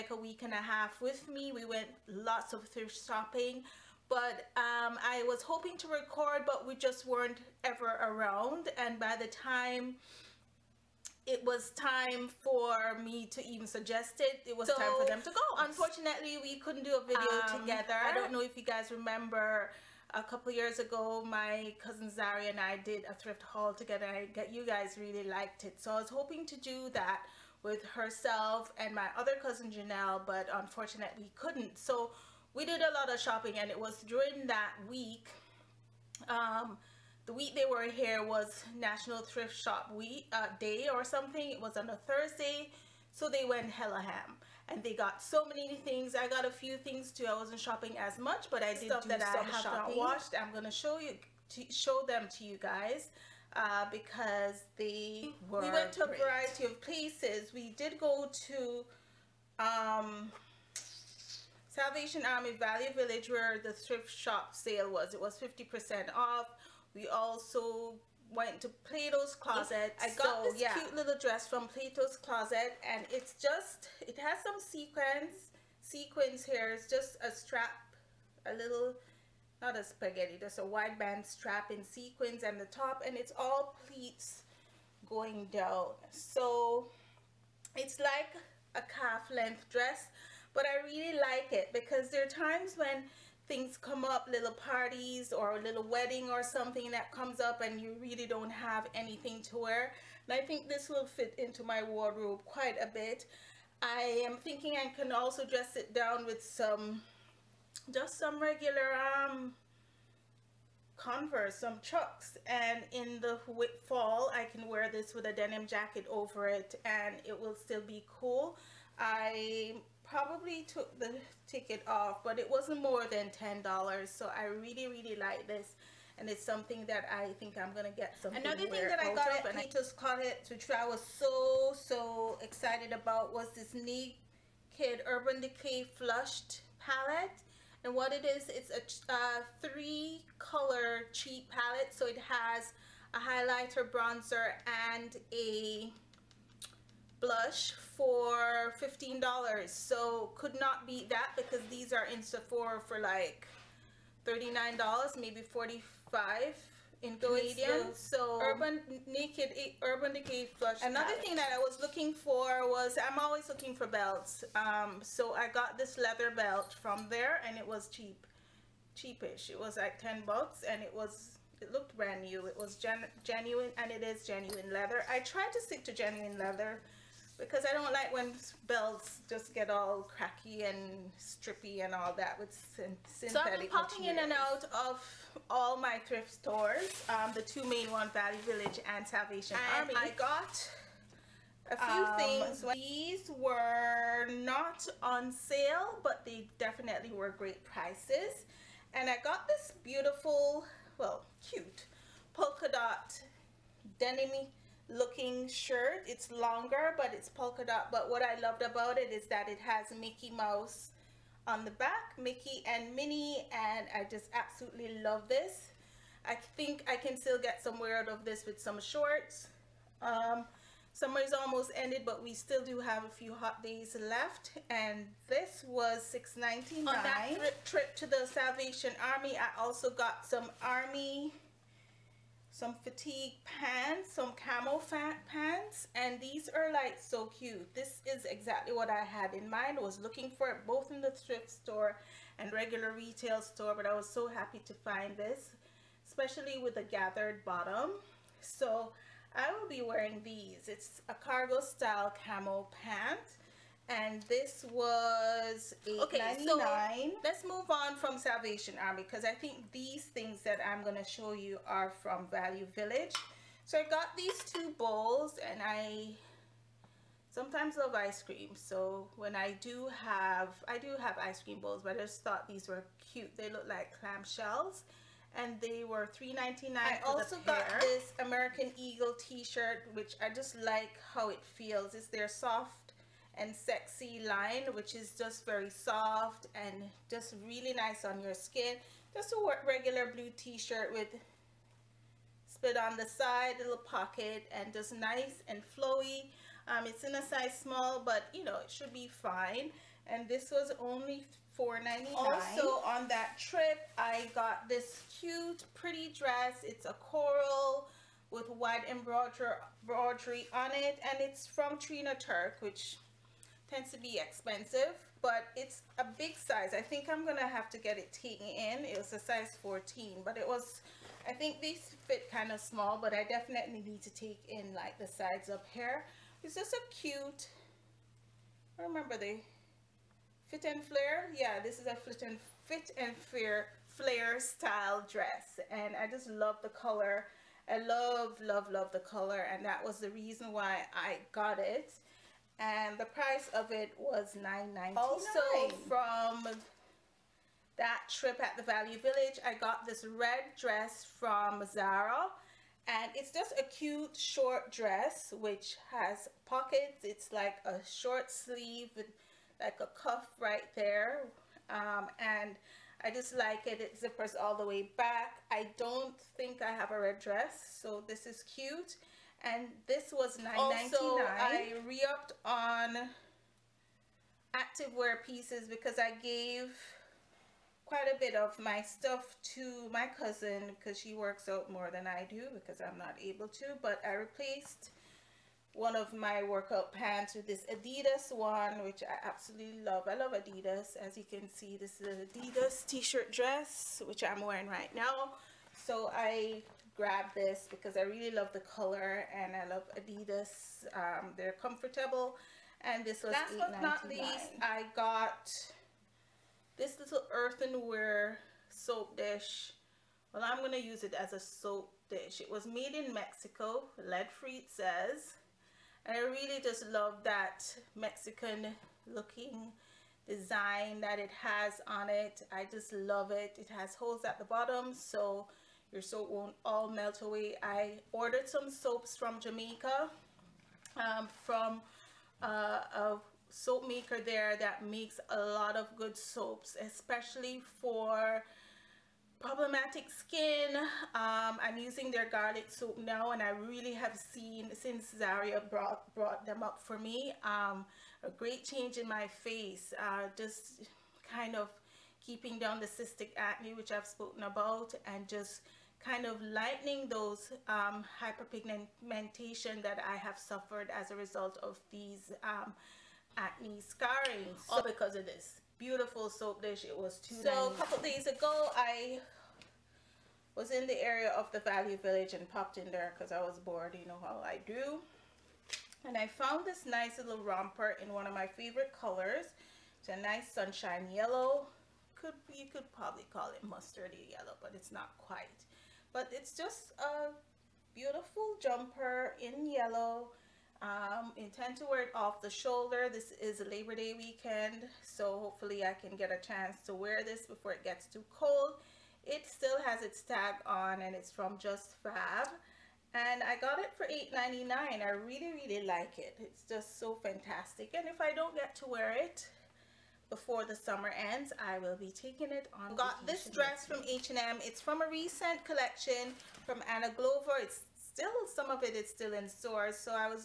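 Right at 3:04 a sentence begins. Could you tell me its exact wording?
in and out of all my thrift stores, um, the two main ones: Value Village and Salvation and Army.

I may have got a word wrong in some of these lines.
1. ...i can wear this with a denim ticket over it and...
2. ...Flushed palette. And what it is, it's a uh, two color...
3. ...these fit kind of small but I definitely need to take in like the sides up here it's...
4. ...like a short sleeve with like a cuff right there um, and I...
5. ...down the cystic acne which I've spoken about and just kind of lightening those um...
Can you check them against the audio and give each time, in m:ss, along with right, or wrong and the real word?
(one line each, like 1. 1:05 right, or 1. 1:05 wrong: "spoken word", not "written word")
1. 1:54 wrong: "jacket", not "ticket"
2. 2:15 wrong: "three", not "two"
3. 5:21 right
4. 5:57 right
5. 7:32 right.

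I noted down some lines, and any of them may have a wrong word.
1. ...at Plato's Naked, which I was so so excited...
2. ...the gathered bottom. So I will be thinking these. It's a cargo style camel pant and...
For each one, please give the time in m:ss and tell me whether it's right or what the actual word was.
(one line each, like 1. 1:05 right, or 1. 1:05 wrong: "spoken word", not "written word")
1. 2:09 wrong: "Closet", not "Naked"
2. 4:06 wrong: "wearing", not "thinking".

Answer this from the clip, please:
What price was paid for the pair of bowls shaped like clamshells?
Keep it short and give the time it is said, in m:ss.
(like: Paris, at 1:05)
$3.99, at 4:36.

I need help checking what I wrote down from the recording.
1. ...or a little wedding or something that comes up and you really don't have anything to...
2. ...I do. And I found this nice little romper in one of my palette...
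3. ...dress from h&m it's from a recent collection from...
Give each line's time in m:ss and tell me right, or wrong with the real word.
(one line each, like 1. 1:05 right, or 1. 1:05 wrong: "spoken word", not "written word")
1. 1:35 right
2. 7:54 wrong: "favorite", not "palette"
3. 8:33 right.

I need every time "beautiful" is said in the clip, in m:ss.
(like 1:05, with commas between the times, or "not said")
3:19, 7:45, 8:07.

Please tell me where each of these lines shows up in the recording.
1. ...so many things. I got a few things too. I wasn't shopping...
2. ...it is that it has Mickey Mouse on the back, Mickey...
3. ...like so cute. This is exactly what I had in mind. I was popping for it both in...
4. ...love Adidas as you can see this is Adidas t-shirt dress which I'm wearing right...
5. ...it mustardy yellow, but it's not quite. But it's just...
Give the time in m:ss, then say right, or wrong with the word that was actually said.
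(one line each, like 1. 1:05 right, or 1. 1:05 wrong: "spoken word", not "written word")
1. 0:45 right
2. 3:28 right
3. 3:56 wrong: "looking", not "popping"
4. 6:30 right
5. 8:03 right.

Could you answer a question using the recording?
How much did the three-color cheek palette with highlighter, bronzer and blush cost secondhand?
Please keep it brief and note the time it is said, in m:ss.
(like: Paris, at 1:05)
$15, at 2:28.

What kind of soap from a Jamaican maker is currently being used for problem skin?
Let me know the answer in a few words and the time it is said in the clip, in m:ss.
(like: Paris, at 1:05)
garlic soap, at 7:22.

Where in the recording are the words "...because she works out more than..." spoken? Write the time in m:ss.
6:20.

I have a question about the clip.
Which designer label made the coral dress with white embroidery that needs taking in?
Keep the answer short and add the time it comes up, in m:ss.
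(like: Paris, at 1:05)
Trina Turk, at 5:11.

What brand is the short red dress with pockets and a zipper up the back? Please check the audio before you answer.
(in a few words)
Zara.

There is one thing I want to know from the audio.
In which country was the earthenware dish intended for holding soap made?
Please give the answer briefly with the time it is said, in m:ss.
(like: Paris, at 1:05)
Mexico, at 6:53.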